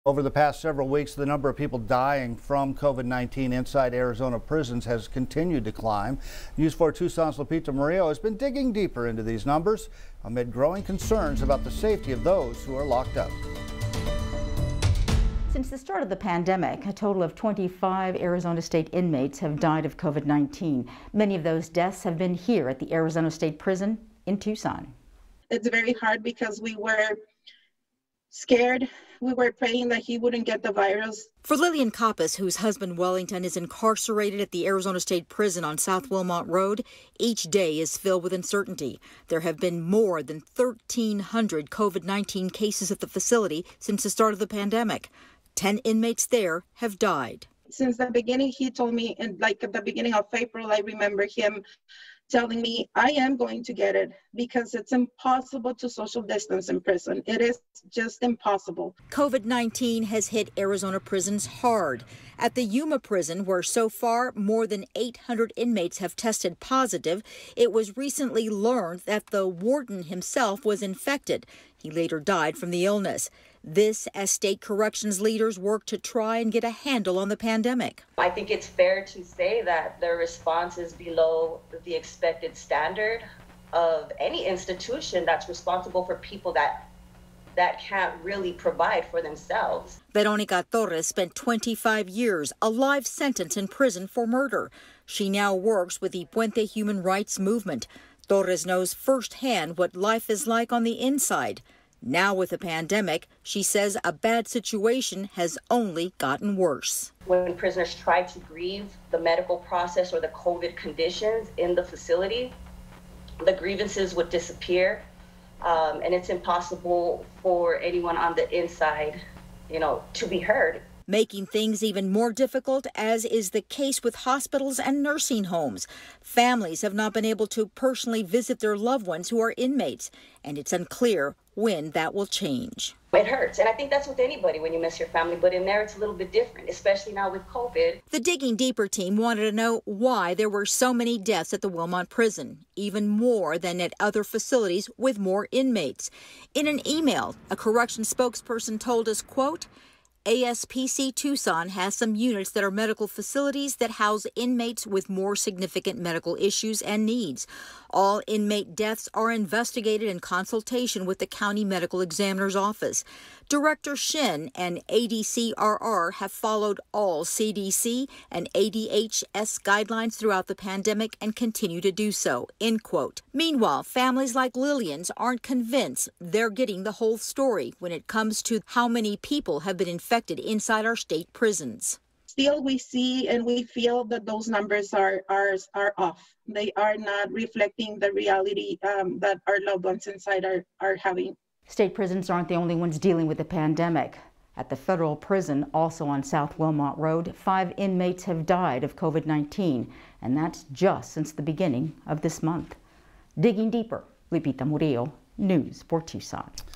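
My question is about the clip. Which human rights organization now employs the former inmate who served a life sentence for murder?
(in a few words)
Puente Human Rights Movement.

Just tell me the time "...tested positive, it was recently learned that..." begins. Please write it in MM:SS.
01:06.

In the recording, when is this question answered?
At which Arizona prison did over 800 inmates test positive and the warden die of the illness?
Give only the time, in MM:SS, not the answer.
01:02.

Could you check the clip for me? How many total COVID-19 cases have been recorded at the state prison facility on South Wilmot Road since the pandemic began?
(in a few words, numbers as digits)
more than 1,300.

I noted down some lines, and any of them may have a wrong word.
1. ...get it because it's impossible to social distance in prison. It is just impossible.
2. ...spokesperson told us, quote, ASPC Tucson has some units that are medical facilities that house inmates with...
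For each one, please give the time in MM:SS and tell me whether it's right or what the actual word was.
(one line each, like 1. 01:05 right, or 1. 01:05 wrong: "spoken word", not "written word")
1. 00:53 right
2. 02:28 right.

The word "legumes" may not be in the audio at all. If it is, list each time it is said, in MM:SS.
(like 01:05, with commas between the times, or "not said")
not said.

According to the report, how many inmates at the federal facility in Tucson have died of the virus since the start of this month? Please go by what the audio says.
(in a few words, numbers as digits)
5.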